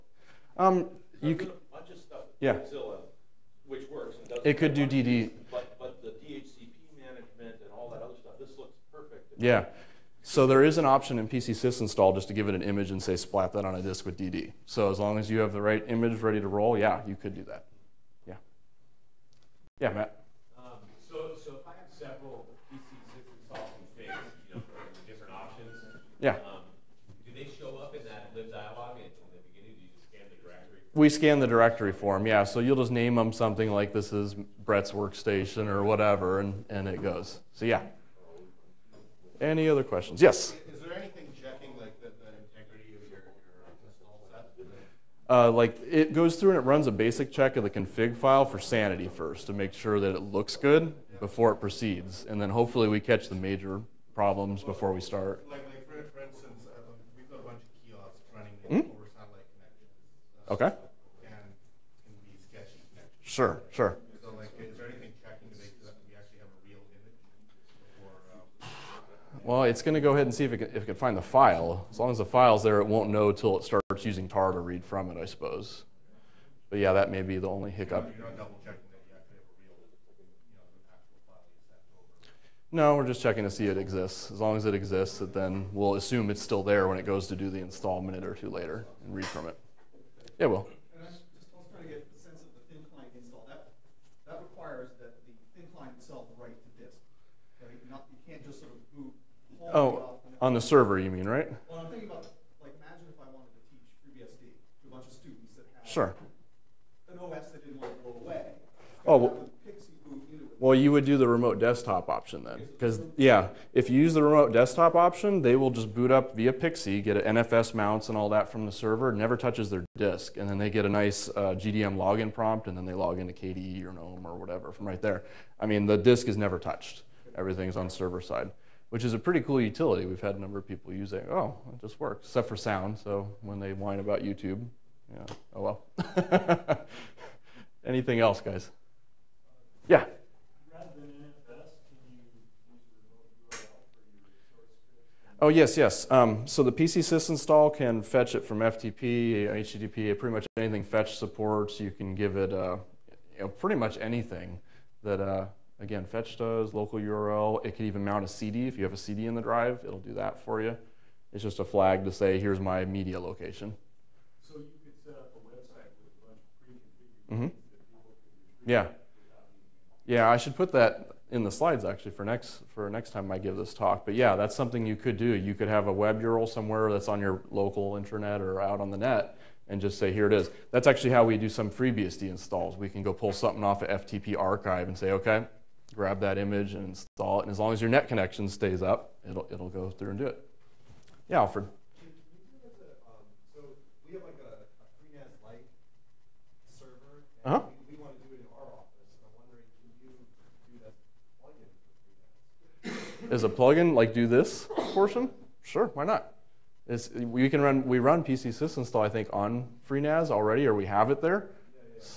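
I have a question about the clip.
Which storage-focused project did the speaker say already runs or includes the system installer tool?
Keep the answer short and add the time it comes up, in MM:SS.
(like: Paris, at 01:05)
FreeNAS, at 03:29.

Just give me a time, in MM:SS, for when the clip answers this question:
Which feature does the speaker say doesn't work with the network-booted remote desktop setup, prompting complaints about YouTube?
02:12.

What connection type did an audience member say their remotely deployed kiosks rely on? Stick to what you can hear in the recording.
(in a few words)
satellite.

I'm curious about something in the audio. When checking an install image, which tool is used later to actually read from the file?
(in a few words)
tar.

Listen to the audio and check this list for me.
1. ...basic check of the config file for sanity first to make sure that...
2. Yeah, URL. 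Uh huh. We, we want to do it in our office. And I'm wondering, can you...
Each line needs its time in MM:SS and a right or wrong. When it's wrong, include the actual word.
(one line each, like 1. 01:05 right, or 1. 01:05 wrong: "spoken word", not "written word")
1. 00:46 right
2. 03:11 wrong: "Alfred", not "URL".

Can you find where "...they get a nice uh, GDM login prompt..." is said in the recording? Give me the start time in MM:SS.
02:00.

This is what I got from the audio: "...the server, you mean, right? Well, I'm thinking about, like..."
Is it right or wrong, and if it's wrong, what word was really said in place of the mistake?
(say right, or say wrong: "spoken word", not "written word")
right.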